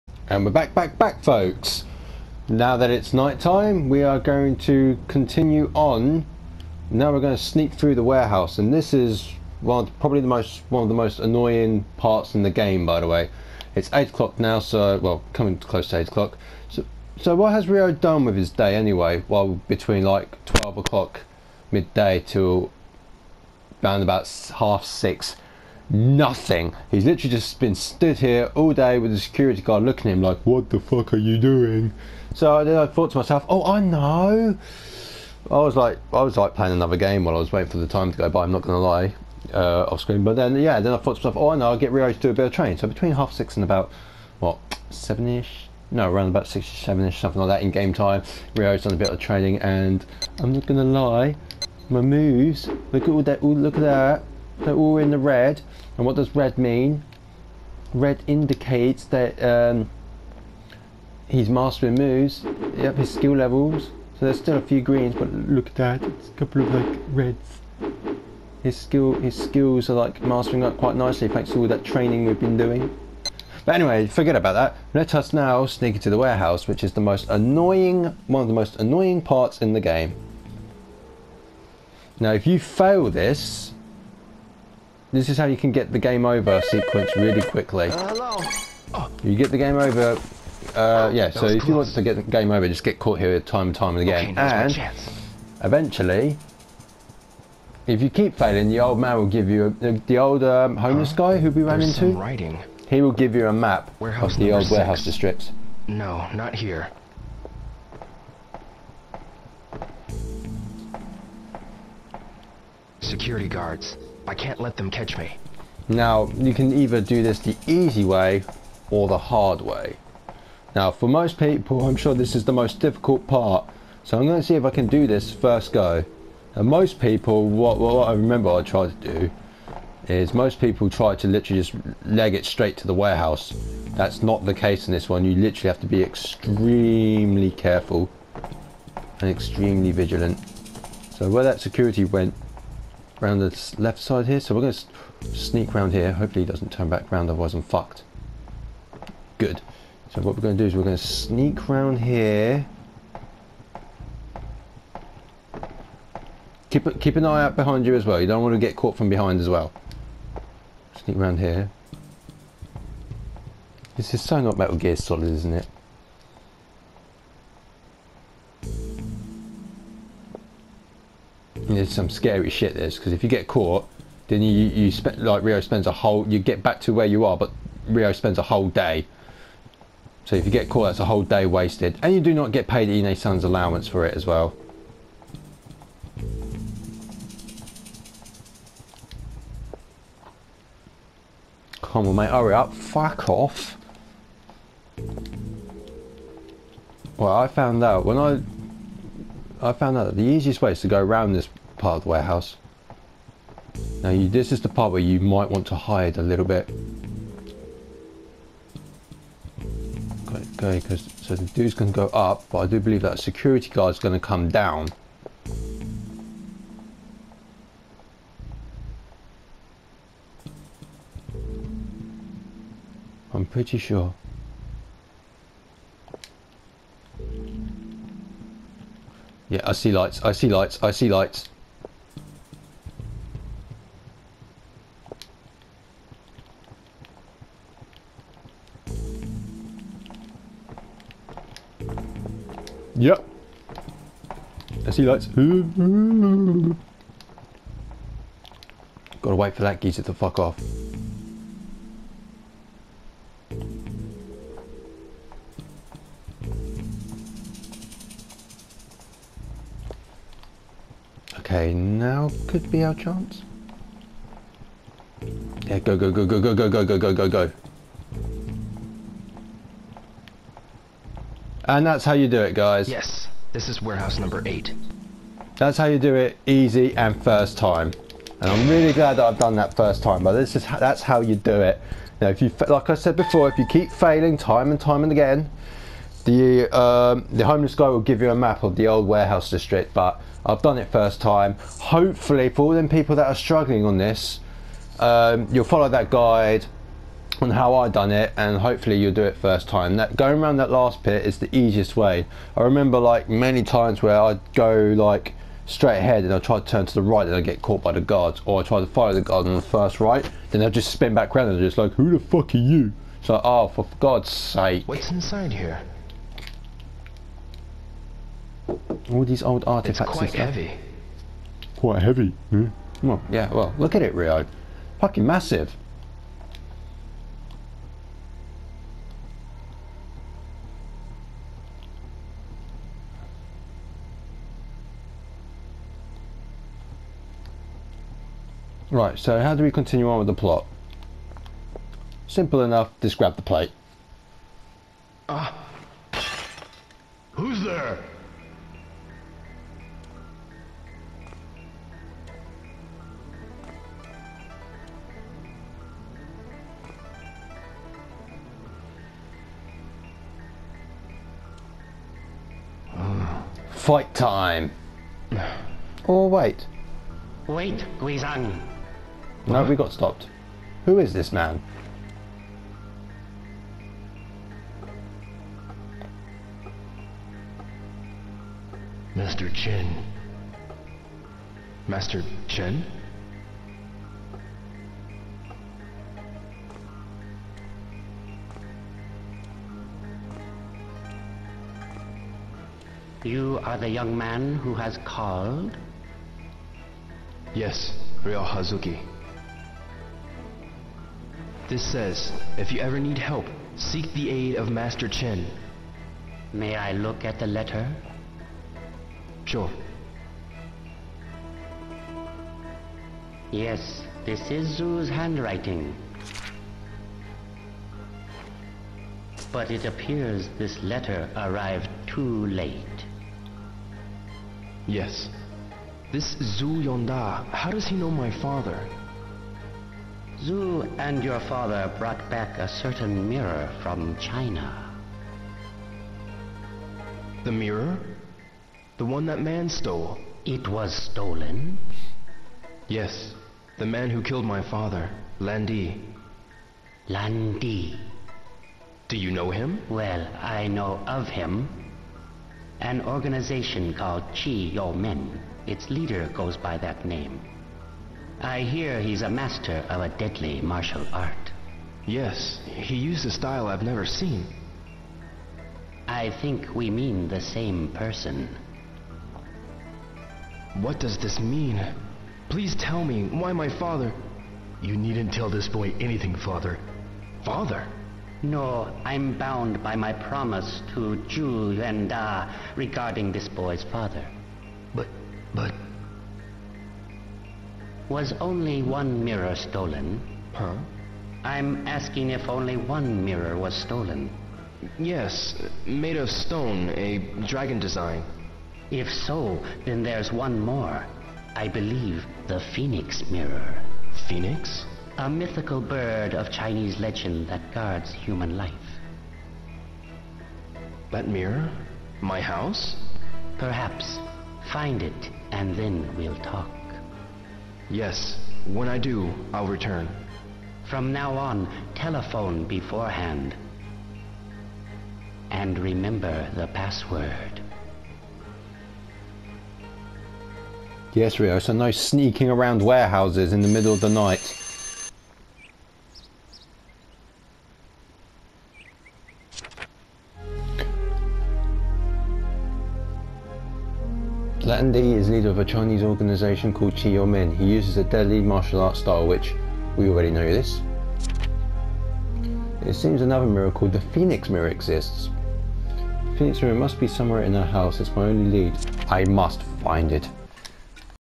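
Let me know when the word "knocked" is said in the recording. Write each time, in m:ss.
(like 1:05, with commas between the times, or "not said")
not said.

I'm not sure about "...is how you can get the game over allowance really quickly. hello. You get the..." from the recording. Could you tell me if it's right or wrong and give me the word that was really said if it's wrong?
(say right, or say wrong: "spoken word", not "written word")
wrong: "sequence", not "allowance".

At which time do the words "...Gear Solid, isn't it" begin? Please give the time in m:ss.
2:44.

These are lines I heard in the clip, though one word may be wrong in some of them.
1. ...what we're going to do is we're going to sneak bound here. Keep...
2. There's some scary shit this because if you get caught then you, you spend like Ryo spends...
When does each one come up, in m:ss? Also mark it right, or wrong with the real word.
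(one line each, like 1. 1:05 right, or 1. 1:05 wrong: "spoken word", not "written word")
1. 2:30 wrong: "round", not "bound"
2. 2:51 right.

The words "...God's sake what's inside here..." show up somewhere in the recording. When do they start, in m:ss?
5:13.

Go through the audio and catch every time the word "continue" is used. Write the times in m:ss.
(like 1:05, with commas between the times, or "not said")
0:05, 5:39.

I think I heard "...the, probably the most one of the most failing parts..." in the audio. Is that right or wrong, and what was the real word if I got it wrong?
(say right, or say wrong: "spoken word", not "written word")
wrong: "annoying", not "failing".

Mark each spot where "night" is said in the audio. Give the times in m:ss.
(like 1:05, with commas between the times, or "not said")
0:03, 8:54.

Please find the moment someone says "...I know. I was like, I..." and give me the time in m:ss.
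0:33.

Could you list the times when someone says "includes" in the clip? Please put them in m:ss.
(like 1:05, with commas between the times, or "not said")
not said.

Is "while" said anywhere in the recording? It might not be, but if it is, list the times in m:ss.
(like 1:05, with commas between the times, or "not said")
0:37.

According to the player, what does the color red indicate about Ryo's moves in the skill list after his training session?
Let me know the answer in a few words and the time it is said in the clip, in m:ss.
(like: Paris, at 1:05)
mastering moves, at 1:01.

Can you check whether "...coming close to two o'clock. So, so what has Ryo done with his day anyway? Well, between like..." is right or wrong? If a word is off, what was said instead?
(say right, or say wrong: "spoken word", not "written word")
wrong: "eight", not "two".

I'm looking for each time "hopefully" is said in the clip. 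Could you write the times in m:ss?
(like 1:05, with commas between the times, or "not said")
2:26, 4:51, 4:58.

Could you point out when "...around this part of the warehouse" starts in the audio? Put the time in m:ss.
3:21.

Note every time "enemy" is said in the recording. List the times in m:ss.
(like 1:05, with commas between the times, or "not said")
not said.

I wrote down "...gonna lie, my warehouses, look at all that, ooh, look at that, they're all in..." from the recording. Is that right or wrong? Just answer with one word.
wrong.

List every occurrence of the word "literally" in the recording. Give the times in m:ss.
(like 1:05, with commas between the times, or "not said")
0:27, 2:11, 2:15.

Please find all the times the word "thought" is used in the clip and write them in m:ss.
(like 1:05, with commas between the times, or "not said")
0:32, 0:40.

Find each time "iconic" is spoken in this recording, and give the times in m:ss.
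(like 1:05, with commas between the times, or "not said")
not said.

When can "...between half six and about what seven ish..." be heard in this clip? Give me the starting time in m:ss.
0:42.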